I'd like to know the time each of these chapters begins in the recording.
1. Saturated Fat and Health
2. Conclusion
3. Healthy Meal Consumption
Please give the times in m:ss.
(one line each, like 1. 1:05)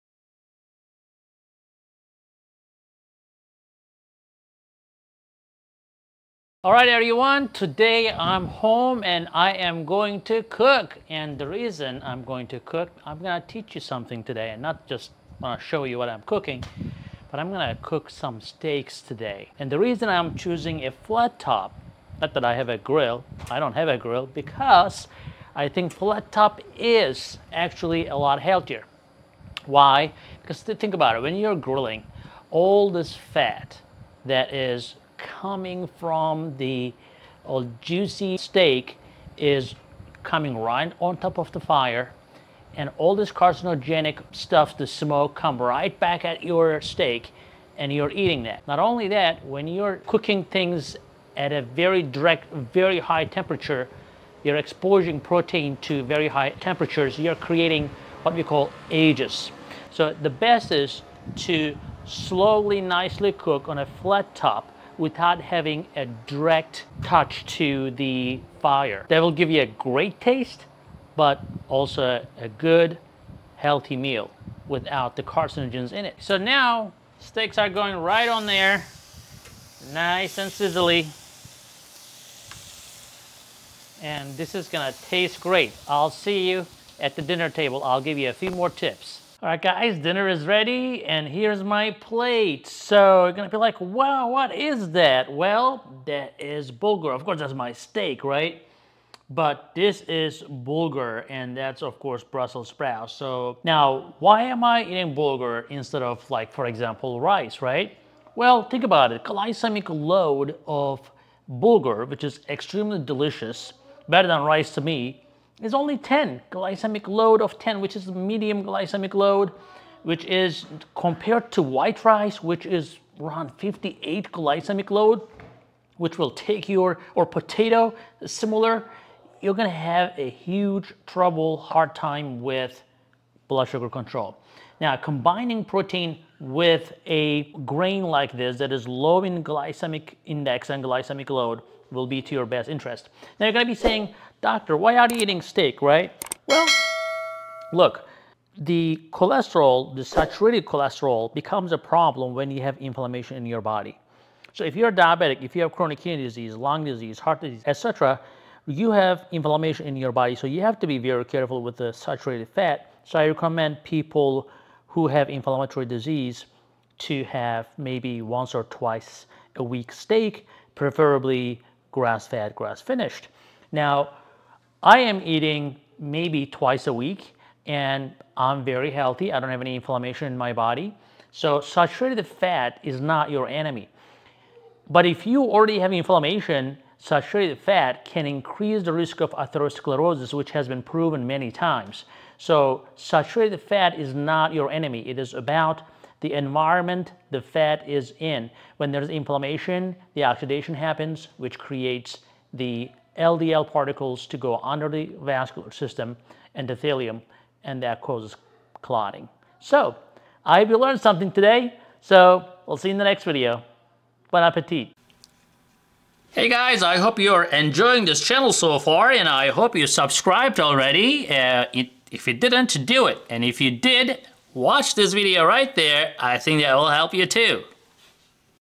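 1. 2:23
2. 3:20
3. 1:23.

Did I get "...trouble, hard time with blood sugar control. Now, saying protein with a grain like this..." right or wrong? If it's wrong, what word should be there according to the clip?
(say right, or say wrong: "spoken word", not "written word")
wrong: "combining", not "saying".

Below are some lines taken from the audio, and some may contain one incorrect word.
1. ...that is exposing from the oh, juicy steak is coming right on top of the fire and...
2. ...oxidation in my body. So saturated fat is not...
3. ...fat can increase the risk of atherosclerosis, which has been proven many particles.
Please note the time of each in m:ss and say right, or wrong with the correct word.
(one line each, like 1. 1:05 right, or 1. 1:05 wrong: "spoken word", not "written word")
1. 0:34 wrong: "coming", not "exposing"
2. 2:59 wrong: "inflammation", not "oxidation"
3. 3:07 wrong: "times", not "particles".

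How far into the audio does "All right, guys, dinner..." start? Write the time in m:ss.
1:29.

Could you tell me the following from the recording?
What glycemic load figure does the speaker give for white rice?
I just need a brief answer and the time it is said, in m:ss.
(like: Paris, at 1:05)
58, at 2:03.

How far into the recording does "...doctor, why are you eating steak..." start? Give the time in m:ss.
2:24.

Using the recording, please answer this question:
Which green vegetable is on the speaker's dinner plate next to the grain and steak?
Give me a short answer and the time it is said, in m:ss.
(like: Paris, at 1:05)
Brussels sprouts, at 1:42.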